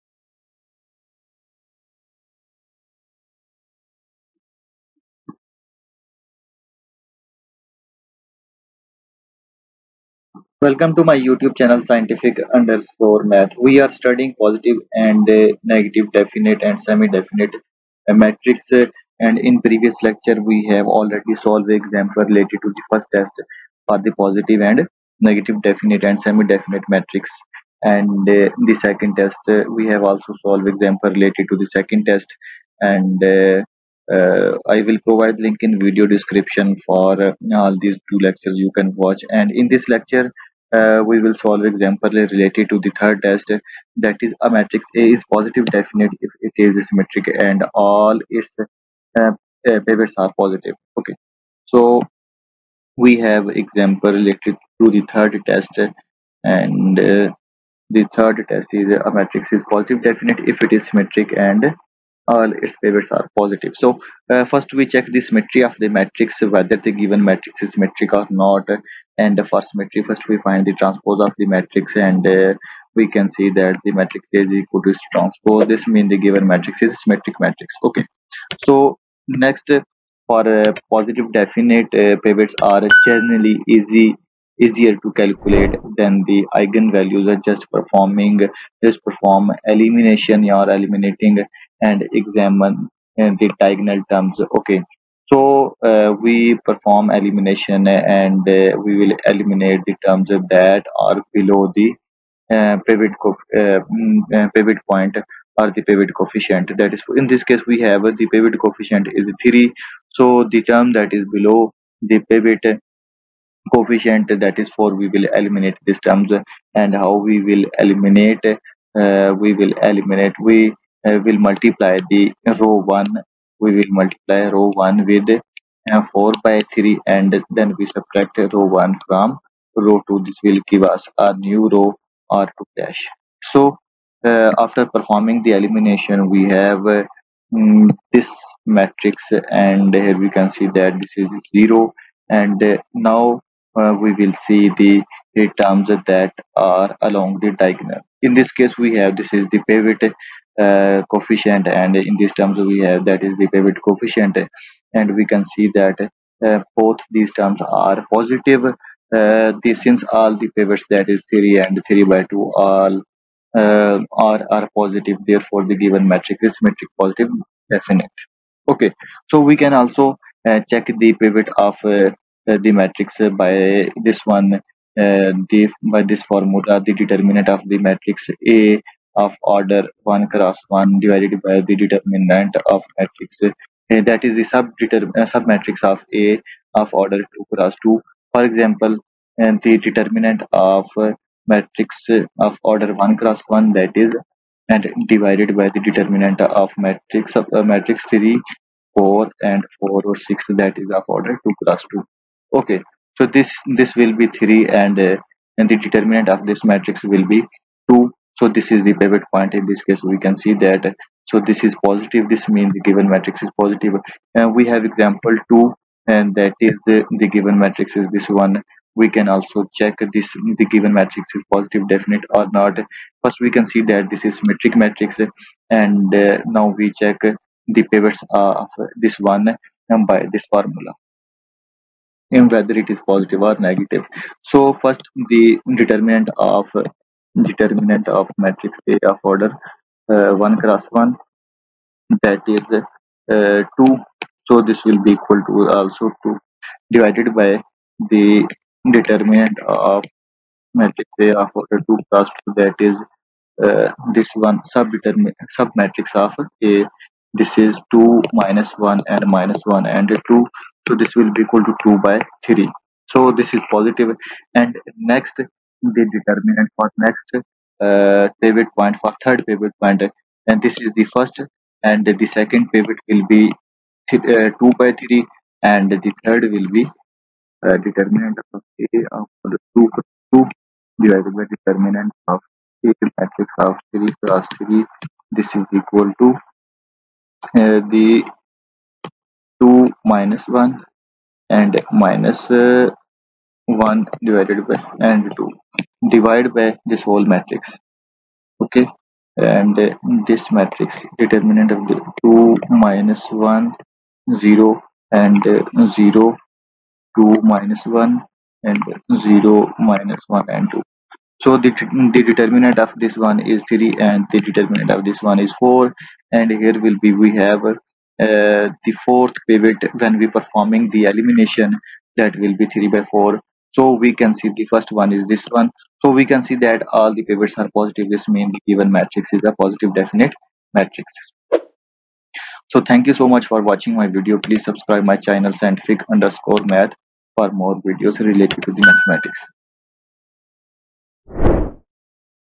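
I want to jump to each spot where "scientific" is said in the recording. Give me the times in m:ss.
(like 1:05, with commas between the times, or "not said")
0:11, 5:35.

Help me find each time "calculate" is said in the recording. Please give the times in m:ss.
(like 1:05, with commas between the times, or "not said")
1:25.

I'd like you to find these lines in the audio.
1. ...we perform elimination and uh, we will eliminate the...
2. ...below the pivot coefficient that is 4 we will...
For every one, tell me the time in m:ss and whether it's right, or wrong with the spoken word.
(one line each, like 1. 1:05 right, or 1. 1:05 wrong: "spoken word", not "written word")
1. 1:36 right
2. 1:51 right.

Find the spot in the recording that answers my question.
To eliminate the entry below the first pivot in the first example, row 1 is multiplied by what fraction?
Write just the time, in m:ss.
2:06.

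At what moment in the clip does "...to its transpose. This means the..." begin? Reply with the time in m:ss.
1:14.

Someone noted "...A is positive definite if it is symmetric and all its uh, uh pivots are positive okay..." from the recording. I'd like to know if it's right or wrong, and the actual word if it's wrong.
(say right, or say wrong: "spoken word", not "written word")
right.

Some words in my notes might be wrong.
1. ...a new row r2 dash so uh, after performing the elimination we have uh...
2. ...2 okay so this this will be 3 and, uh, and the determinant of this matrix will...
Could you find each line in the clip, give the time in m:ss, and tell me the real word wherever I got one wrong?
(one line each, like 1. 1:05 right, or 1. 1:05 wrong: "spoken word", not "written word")
1. 2:11 right
2. 3:21 right.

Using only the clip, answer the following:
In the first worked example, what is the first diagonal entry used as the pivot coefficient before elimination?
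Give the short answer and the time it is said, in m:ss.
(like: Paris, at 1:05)
3, at 1:47.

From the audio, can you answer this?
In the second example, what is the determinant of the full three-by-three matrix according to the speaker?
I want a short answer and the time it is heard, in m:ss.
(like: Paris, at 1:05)
4, at 5:14.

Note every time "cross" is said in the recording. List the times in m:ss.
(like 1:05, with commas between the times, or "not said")
3:00, 3:07, 3:13, 3:21, 4:00, 4:12, 4:44.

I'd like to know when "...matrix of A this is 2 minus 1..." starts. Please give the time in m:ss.
4:15.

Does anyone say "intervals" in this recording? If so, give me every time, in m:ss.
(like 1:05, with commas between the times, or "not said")
not said.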